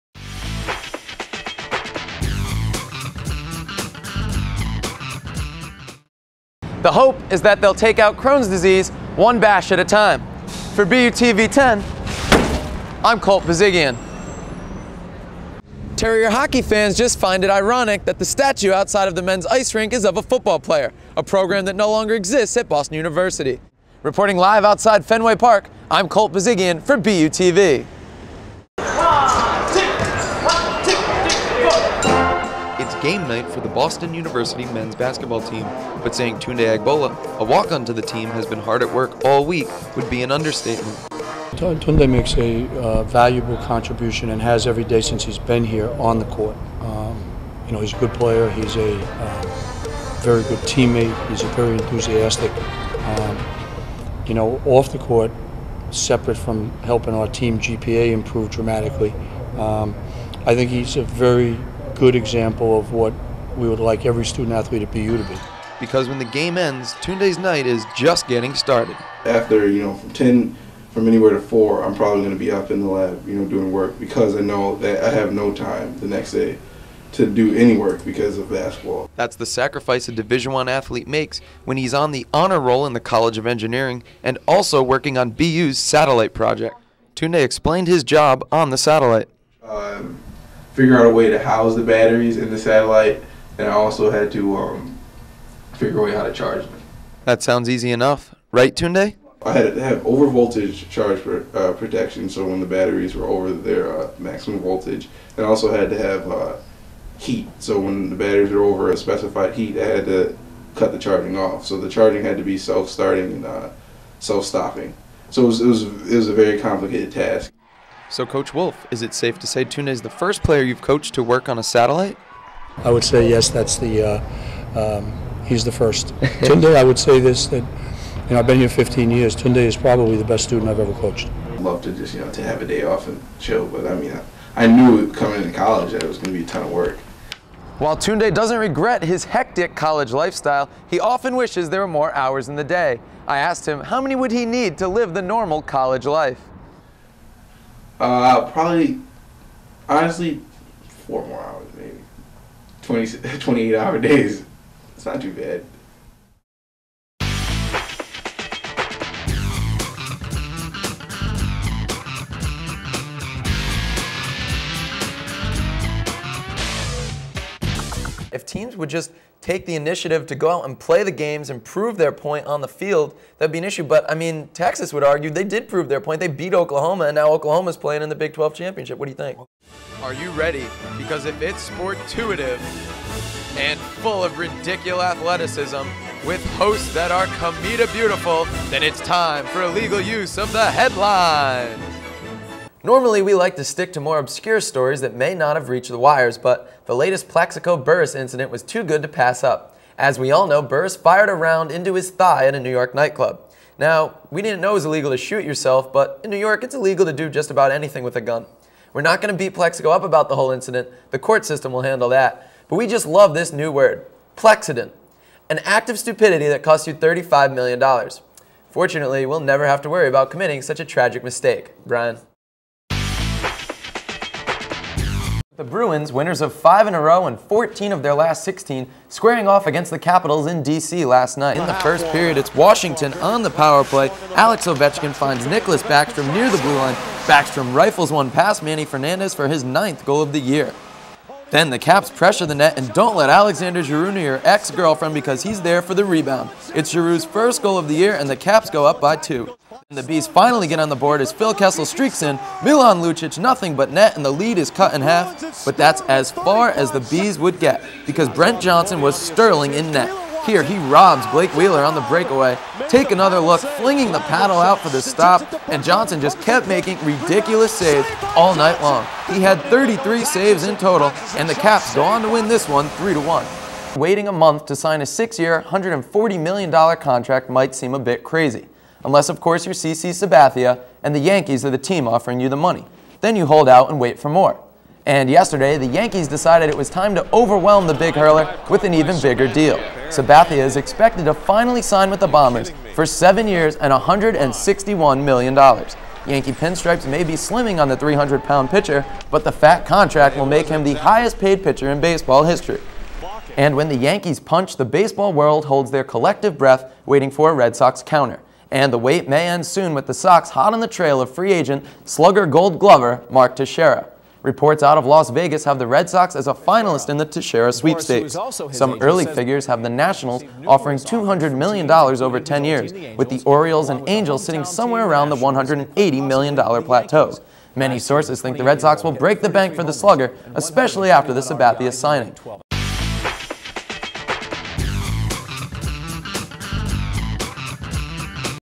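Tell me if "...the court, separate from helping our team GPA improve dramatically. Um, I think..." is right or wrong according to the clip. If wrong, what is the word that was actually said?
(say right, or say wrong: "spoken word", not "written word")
right.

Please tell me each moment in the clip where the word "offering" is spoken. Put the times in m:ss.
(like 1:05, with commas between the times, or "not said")
4:42, 5:20.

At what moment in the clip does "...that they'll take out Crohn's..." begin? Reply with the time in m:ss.
0:07.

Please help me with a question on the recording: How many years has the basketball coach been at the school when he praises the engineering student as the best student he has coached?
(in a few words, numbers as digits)
15.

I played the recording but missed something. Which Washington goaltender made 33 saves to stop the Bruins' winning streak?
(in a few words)
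Brent Johnson.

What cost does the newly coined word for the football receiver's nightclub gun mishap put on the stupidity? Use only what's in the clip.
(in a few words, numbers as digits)
$35 million.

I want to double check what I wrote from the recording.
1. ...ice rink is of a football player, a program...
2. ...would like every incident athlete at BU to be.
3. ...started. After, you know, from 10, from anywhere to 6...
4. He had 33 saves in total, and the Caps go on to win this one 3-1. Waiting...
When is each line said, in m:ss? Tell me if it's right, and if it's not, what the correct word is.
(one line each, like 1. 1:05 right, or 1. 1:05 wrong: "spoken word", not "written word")
1. 0:19 right
2. 1:03 wrong: "student", not "incident"
3. 1:08 wrong: "4", not "6"
4. 4:29 right.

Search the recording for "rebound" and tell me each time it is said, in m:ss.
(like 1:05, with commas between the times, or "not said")
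4:06.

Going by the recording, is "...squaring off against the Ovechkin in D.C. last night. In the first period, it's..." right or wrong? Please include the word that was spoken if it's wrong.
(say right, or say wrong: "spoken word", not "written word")
wrong: "Capitals", not "Ovechkin".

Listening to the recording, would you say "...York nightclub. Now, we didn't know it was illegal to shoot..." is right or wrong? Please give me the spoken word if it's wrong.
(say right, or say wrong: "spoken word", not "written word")
right.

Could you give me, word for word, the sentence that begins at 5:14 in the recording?
Reports out of Las Vegas have the Red Sox as a finalist in the Teixeira sweepstakes.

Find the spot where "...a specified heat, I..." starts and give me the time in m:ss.
1:48.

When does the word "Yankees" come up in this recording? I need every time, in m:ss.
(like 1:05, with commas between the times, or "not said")
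4:41, 4:45, 4:55, 5:03.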